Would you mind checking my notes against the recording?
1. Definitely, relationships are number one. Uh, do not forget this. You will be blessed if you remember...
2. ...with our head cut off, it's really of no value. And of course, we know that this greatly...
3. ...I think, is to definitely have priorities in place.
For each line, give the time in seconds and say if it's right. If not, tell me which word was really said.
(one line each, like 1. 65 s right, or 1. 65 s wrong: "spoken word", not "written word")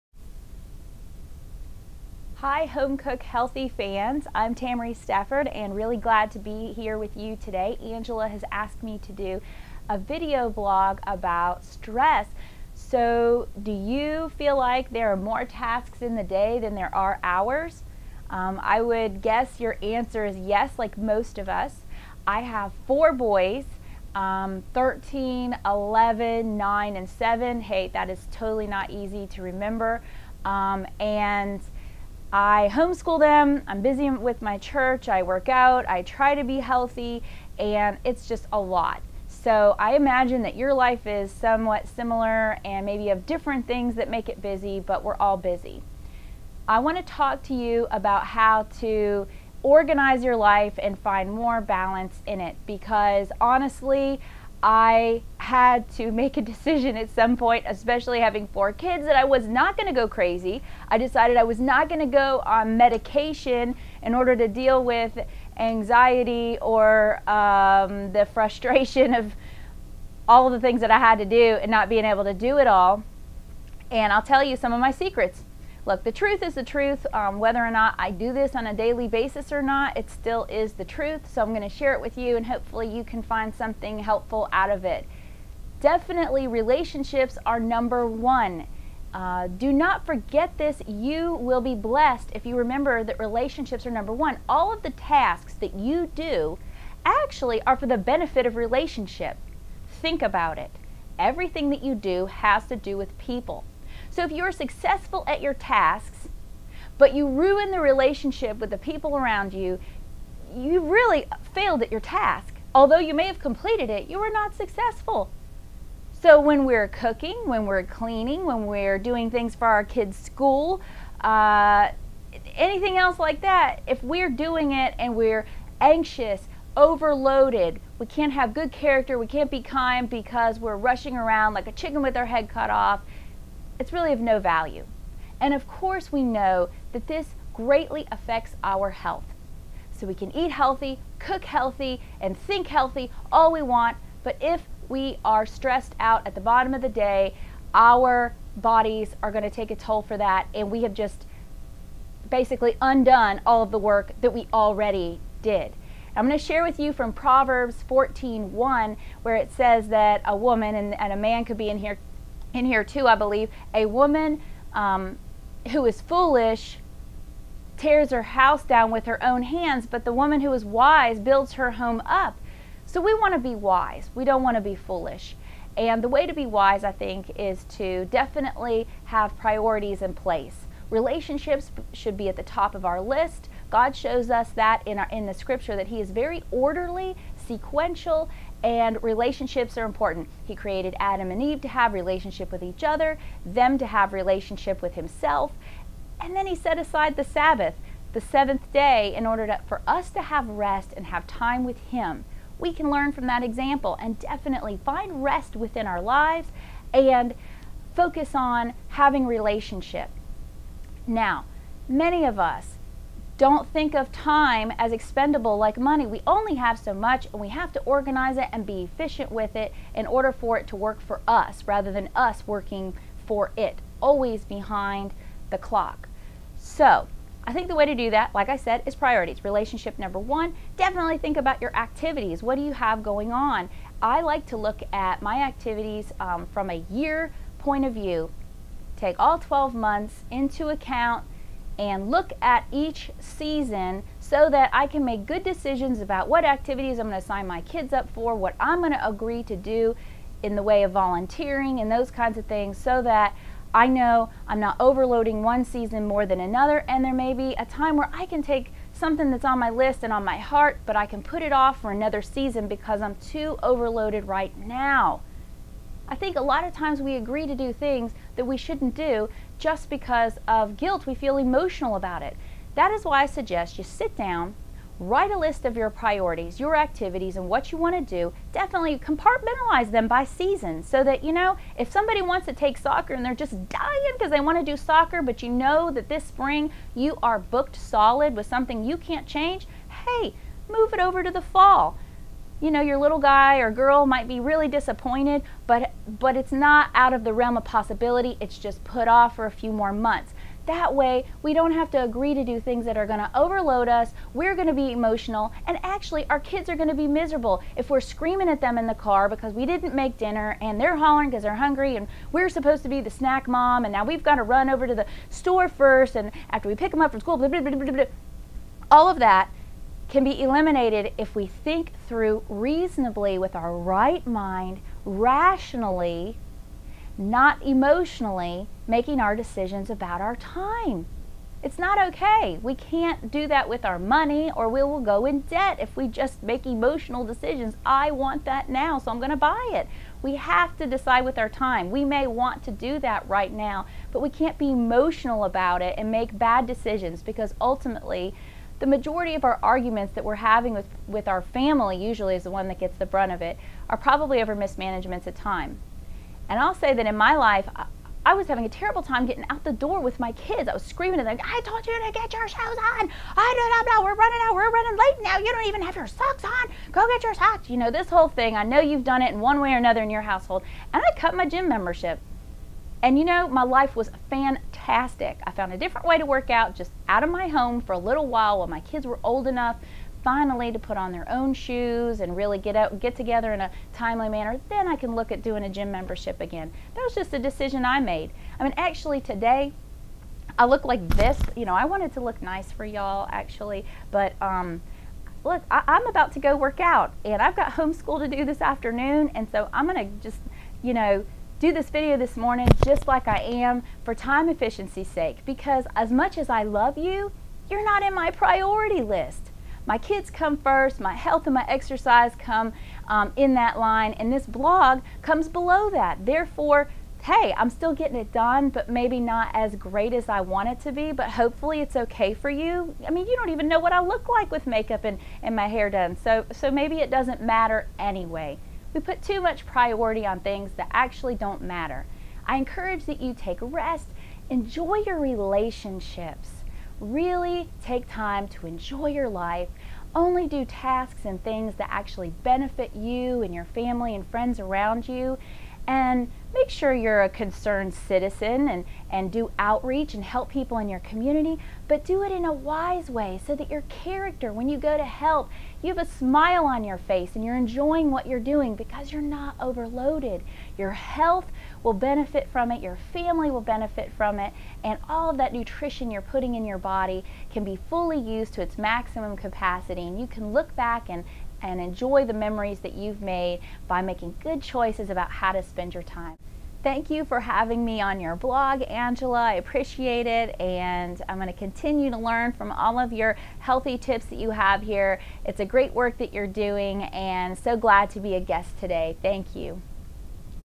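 1. 85 s right
2. 132 s right
3. 176 s right.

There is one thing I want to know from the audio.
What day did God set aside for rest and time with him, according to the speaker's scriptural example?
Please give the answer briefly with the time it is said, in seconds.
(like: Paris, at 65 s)
the Sabbath, at 197 s.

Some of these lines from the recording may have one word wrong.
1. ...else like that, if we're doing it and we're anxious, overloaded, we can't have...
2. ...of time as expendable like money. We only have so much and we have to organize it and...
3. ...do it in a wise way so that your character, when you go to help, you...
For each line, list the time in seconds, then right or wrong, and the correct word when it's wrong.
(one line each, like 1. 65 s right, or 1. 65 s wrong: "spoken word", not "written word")
1. 122 s right
2. 213 s right
3. 452 s right.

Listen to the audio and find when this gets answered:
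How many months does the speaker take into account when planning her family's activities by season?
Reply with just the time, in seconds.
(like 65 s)
239 s.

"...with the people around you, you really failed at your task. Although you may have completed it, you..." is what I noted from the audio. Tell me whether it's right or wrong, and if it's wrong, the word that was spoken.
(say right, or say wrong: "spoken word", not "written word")
right.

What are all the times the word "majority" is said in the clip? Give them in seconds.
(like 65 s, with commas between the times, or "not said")
348 s.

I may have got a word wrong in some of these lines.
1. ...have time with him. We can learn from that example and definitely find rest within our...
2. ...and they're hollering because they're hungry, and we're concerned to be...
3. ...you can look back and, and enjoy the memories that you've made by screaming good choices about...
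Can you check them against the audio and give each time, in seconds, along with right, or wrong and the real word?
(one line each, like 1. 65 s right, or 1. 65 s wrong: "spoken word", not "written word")
1. 201 s right
2. 310 s wrong: "supposed", not "concerned"
3. 470 s wrong: "making", not "screaming".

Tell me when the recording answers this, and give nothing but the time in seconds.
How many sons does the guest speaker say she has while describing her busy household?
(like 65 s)
22 s.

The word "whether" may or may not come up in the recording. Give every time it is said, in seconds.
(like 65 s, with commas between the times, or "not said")
77 s.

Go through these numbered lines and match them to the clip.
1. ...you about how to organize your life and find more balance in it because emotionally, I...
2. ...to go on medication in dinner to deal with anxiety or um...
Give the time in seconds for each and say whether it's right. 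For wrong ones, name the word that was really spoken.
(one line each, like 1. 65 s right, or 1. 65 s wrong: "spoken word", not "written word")
1. 47 s wrong: "honestly", not "emotionally"
2. 61 s wrong: "order", not "dinner".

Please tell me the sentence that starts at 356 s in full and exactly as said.
And I'll say that in my life, I, I was having a terrible time getting out the door with my kids.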